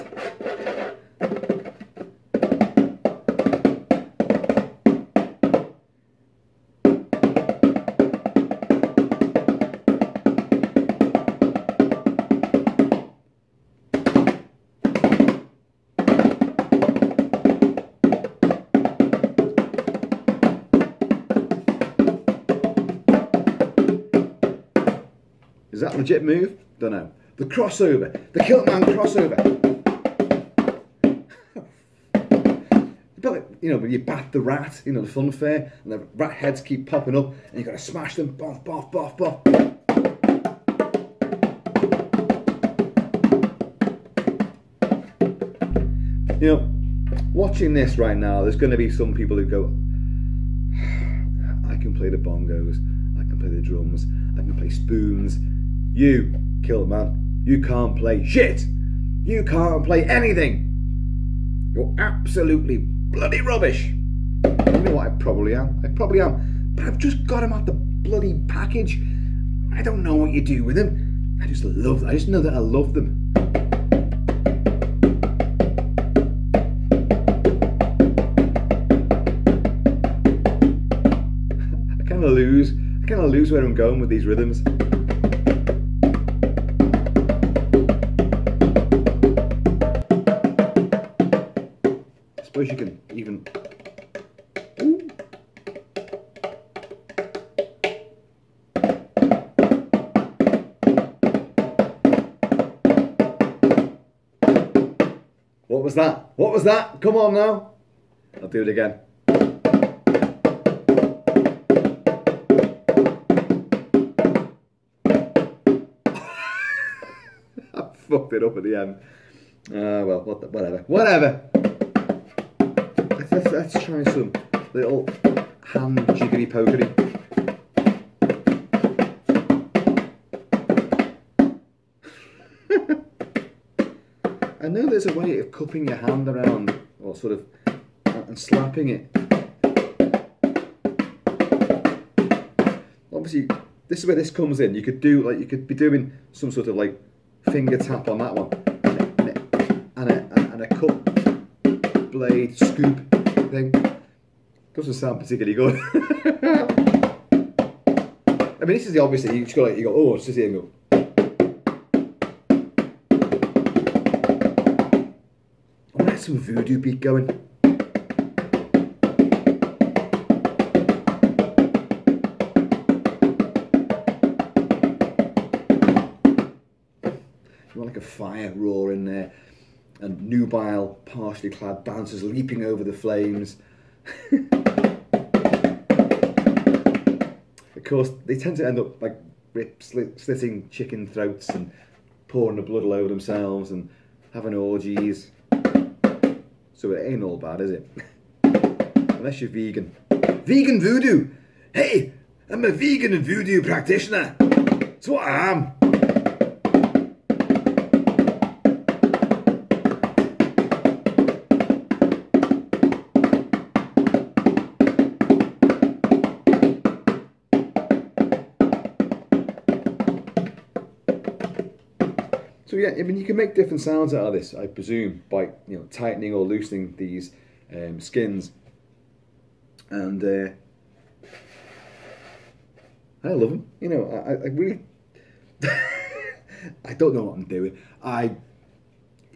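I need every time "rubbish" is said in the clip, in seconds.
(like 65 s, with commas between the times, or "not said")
63 s.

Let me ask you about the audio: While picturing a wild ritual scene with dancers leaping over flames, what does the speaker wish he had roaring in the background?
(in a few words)
fire roar.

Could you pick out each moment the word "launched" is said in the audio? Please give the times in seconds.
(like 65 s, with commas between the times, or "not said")
not said.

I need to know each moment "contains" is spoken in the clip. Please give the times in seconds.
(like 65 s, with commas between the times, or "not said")
not said.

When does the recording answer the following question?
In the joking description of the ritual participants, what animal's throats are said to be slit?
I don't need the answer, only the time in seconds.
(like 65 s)
190 s.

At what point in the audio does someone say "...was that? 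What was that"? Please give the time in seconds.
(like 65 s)
105 s.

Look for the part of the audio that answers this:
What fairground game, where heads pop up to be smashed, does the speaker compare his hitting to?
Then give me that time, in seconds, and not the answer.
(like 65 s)
33 s.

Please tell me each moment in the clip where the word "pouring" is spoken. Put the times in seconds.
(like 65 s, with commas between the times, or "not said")
192 s.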